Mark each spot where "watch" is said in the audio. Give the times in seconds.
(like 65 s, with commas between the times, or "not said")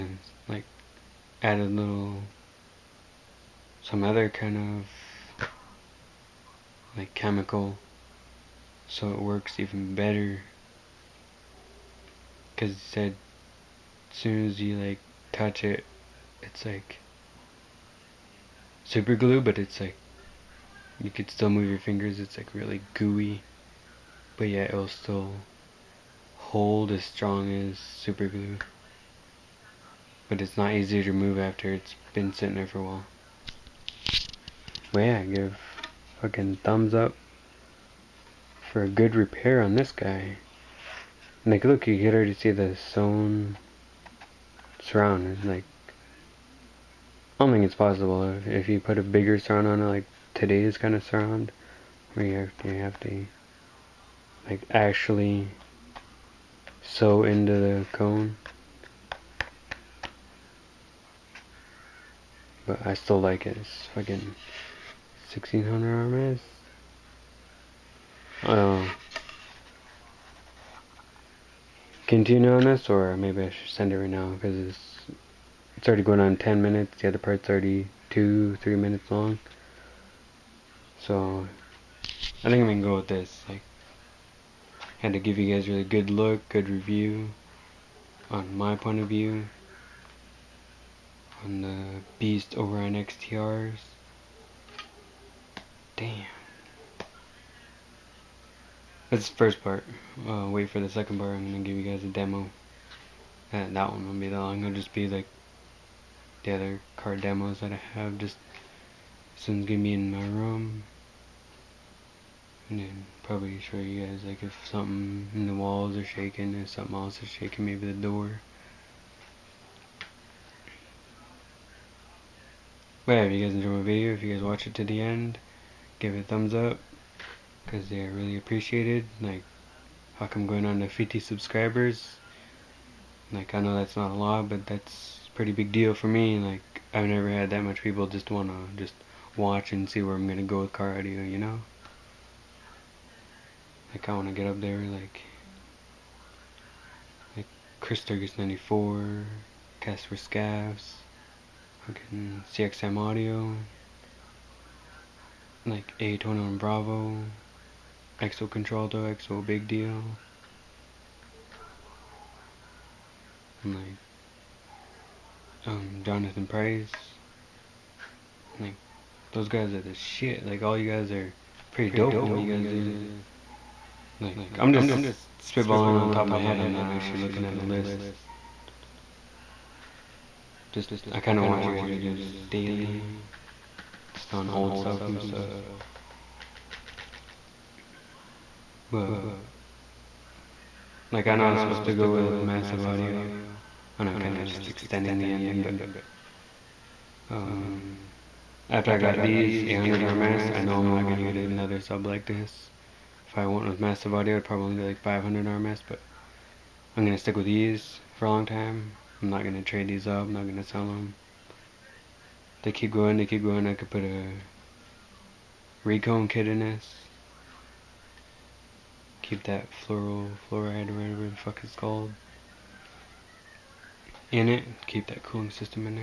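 124 s, 139 s, 181 s.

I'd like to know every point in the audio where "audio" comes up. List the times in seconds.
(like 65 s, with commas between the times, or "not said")
140 s, 152 s, 192 s, 204 s.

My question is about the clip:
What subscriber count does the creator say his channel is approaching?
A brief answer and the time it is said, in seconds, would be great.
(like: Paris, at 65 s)
50, at 130 s.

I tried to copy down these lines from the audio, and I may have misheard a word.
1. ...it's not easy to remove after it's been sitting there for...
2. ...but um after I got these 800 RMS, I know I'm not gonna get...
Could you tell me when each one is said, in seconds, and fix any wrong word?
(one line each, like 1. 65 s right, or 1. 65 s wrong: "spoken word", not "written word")
1. 30 s right
2. 195 s right.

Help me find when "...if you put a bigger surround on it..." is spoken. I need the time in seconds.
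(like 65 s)
48 s.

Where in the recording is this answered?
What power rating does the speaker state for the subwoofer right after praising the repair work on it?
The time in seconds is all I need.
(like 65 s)
65 s.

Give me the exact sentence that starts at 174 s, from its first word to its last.
Like I'm just spitballing on top of my head.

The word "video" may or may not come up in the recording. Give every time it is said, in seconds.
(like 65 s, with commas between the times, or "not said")
123 s, 181 s.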